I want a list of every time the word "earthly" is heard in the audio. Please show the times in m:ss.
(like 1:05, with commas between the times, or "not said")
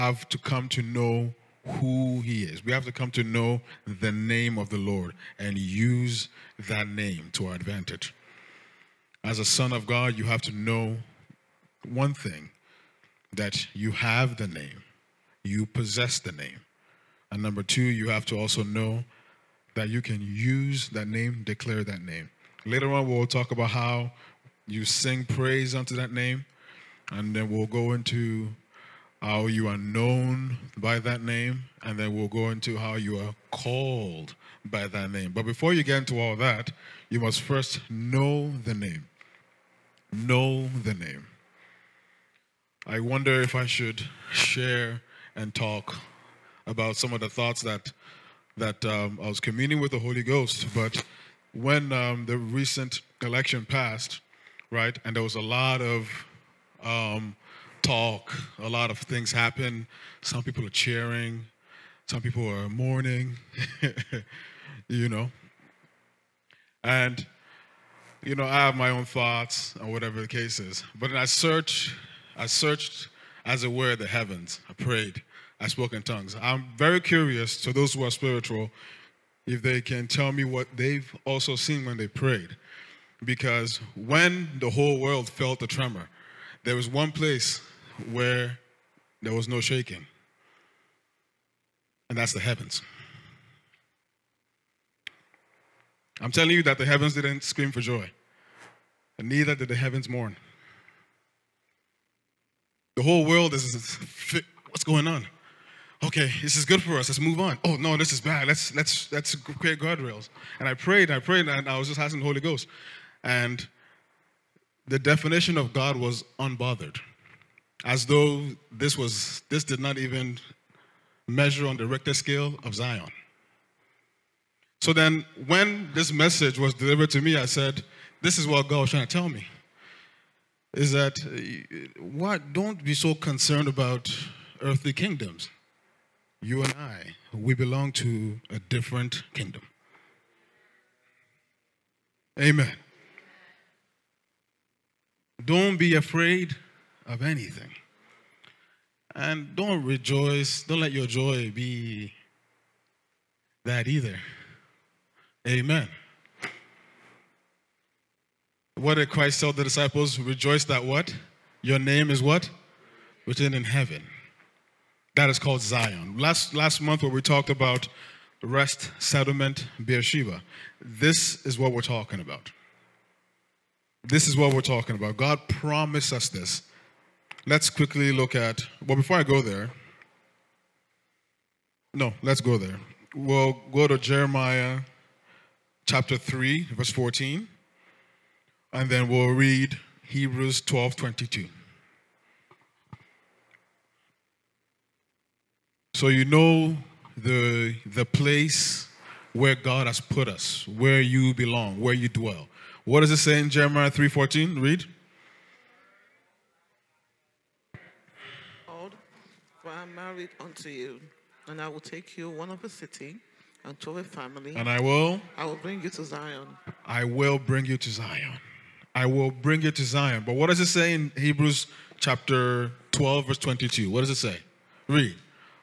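2:14.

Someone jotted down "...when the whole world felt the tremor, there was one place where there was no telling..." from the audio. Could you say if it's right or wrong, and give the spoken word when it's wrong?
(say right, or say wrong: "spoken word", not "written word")
wrong: "shaking", not "telling".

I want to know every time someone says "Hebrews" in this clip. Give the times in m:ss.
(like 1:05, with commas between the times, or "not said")
3:10, 3:41.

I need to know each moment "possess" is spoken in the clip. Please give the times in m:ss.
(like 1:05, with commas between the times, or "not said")
0:15.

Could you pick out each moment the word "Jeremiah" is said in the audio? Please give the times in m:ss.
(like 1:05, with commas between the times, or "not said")
3:03, 3:23.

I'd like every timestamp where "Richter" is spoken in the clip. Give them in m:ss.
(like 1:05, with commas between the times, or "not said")
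2:01.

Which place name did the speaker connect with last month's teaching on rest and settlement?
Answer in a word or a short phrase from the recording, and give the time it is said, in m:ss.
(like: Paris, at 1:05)
Beersheba, at 2:49.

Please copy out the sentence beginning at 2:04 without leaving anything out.
So then, when this message was delivered to me, I said, This is what God was trying to tell me.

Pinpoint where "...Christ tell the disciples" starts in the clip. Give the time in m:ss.
2:39.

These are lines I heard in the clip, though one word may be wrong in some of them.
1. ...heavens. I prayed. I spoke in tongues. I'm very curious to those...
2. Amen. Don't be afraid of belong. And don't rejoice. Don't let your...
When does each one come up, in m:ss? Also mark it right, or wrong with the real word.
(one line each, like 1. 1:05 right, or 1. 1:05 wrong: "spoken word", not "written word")
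1. 1:14 right
2. 2:22 wrong: "anything", not "belong".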